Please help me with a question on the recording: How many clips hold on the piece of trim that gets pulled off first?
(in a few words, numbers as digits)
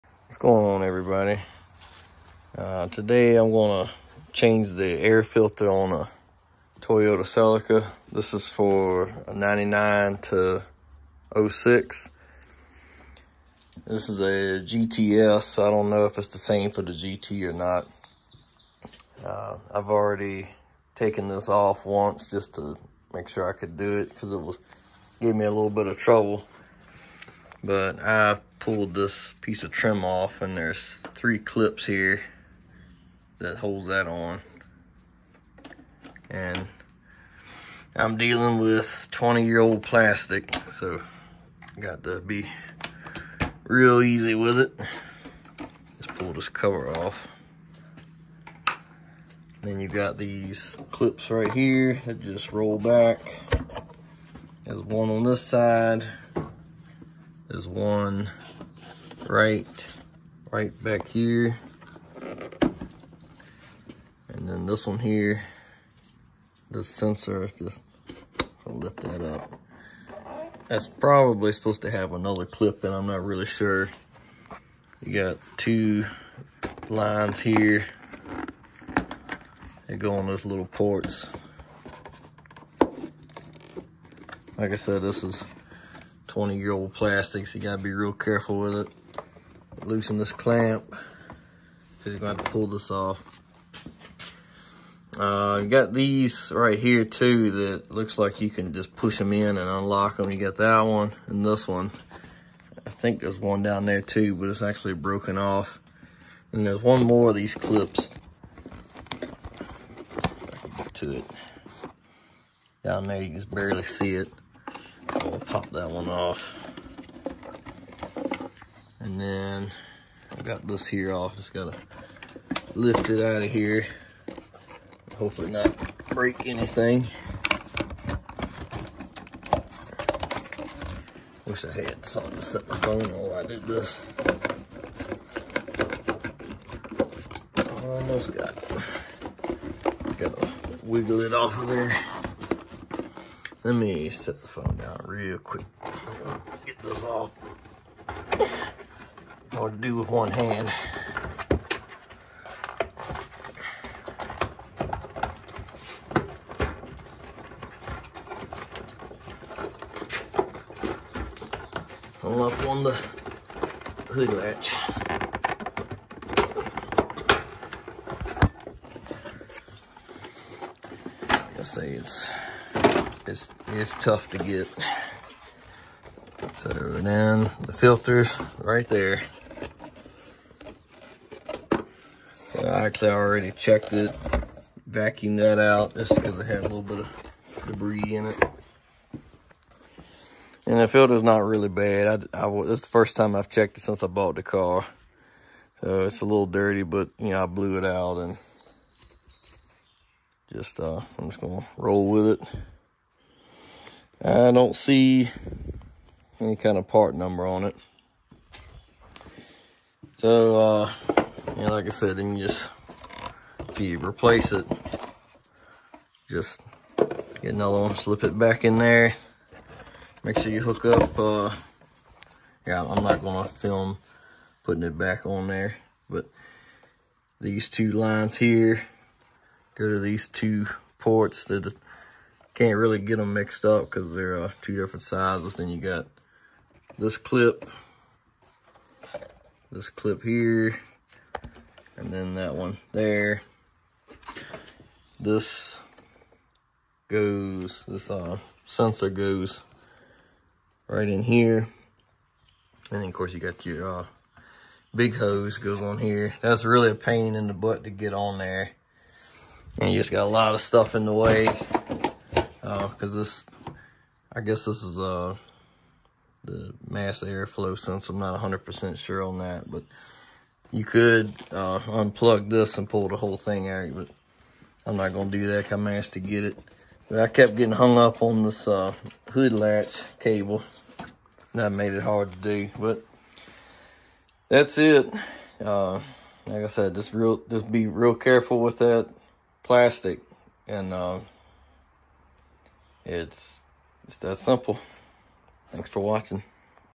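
3.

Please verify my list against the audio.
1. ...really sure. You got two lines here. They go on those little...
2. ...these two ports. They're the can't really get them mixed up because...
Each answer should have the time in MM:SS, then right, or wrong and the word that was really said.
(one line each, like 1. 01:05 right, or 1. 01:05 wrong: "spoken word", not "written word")
1. 01:13 right
2. 03:49 right.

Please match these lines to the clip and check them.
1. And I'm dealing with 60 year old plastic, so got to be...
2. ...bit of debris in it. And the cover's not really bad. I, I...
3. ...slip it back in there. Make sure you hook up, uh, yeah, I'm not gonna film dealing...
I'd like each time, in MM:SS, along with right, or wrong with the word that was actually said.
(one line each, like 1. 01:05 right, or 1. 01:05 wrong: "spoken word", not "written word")
1. 00:36 wrong: "20", not "60"
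2. 03:06 wrong: "filter", not "cover"
3. 03:37 wrong: "putting", not "dealing".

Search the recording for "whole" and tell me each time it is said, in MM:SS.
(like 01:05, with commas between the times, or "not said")
04:33.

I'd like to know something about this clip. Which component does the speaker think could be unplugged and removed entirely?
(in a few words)
Mass airflow sensor.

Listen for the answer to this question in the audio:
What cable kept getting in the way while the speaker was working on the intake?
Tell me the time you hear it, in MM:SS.
04:39.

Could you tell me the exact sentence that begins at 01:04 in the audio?
And then this one here, this sensor, is just so lift that up.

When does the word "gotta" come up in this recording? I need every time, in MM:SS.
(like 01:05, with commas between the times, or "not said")
01:27, 02:01, 02:20.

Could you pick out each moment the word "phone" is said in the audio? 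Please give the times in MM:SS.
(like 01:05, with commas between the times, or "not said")
02:12, 02:24.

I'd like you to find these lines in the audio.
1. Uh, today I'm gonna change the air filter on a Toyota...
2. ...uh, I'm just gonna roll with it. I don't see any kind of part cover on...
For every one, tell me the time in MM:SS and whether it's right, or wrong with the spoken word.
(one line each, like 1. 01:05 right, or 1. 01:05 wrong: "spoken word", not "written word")
1. 00:02 right
2. 03:20 wrong: "number", not "cover".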